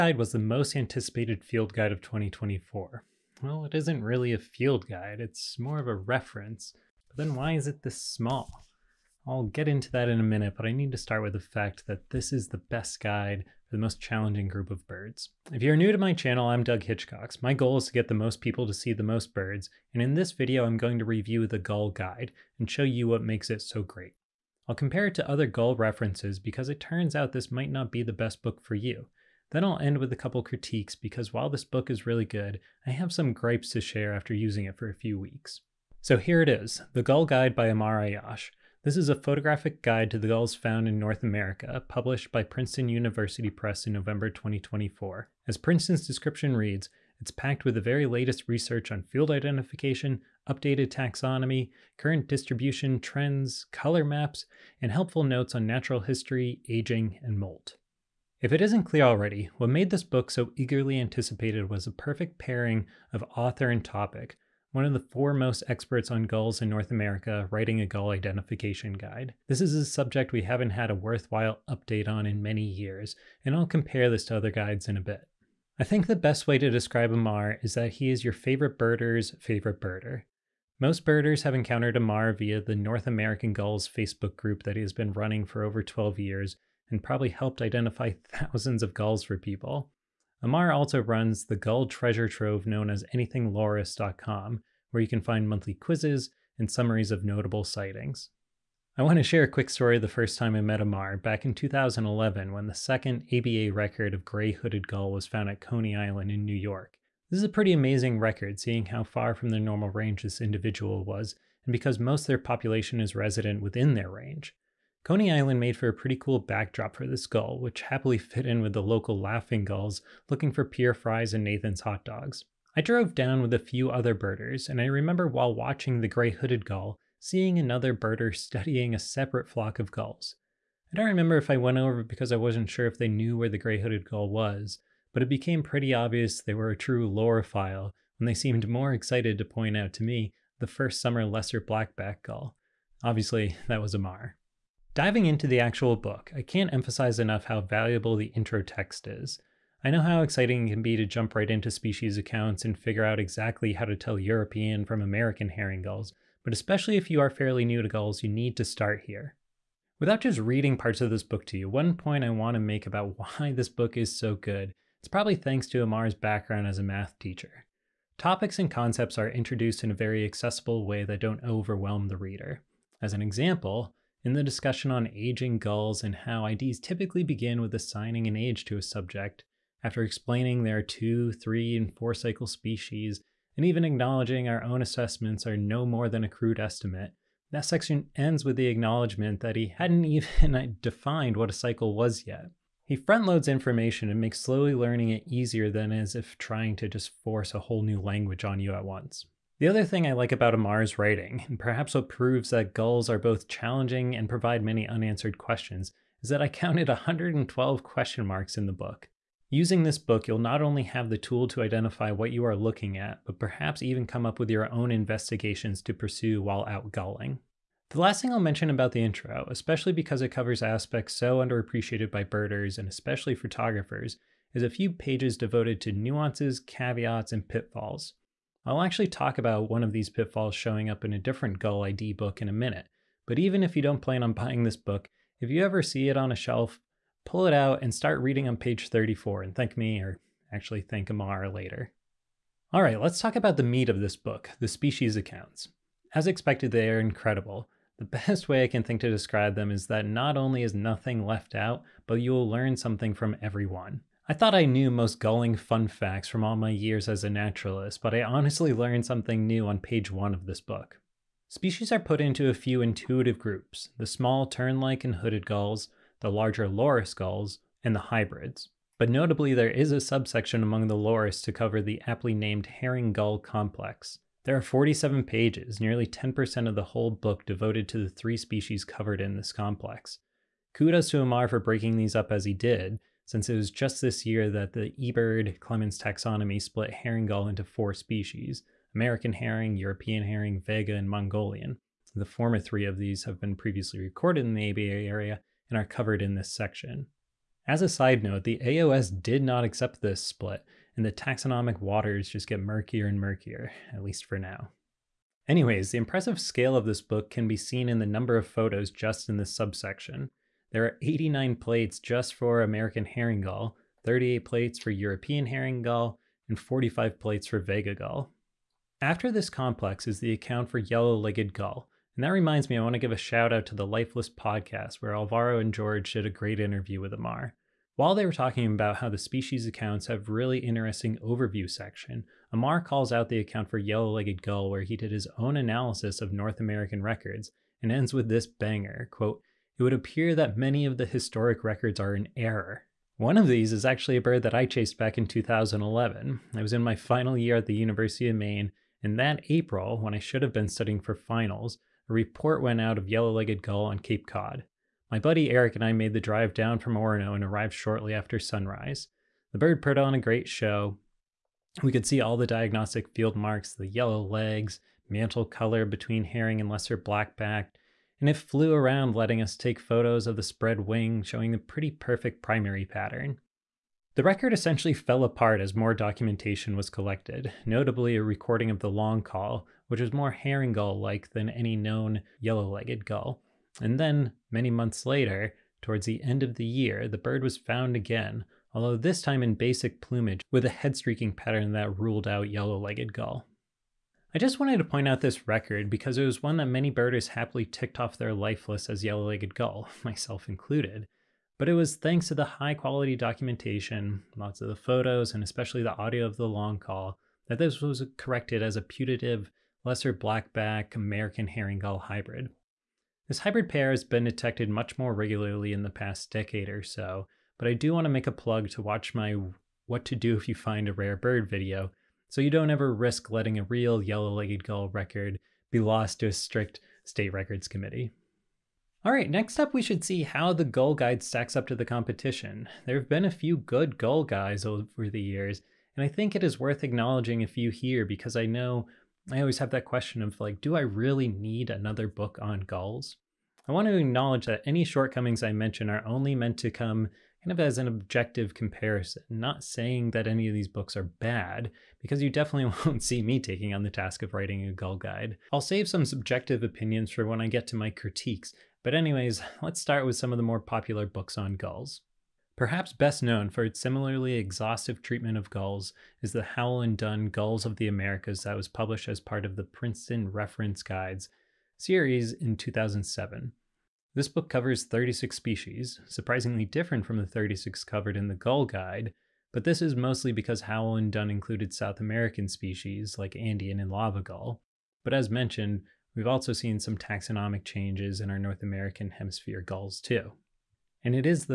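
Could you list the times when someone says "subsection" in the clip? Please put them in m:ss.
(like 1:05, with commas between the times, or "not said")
4:29, 5:09.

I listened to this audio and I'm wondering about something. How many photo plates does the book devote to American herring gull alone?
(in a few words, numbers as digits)
89.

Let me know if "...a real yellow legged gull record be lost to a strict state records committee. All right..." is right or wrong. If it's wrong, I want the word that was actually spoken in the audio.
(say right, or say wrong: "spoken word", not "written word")
right.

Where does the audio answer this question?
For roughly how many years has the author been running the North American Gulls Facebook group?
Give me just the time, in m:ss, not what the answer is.
1:25.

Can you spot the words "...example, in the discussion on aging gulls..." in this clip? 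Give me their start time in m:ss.
2:53.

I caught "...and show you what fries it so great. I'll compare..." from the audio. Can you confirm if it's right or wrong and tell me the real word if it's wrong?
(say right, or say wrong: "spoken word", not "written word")
wrong: "makes", not "fries".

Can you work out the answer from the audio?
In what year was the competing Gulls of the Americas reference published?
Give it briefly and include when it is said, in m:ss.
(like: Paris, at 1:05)
2007, at 7:52.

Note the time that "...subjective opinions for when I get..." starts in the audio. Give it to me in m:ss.
7:36.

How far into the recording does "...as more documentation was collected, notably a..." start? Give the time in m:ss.
6:15.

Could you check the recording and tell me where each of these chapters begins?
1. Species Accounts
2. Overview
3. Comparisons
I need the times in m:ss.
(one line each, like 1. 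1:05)
1. 4:04
2. 0:35
3. 7:11.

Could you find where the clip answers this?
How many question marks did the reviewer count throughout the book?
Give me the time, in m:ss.
3:26.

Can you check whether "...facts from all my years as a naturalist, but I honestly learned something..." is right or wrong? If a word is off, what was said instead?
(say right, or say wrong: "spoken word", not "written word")
right.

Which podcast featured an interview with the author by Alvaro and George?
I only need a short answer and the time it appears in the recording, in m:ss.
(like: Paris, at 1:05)
Lifeless podcast, at 5:23.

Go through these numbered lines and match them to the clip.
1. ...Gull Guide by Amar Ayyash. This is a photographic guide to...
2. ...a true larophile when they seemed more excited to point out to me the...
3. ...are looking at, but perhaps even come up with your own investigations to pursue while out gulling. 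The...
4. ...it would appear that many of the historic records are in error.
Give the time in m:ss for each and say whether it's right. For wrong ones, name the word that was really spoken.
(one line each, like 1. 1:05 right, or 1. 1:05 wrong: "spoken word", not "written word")
1. 0:37 right
2. 2:16 right
3. 3:32 right
4. 5:39 right.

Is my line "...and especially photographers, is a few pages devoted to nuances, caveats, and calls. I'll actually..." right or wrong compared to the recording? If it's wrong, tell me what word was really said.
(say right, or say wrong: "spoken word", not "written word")
wrong: "pitfalls", not "calls".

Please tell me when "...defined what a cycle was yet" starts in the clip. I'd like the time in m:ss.
3:10.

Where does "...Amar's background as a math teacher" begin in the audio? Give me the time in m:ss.
2:45.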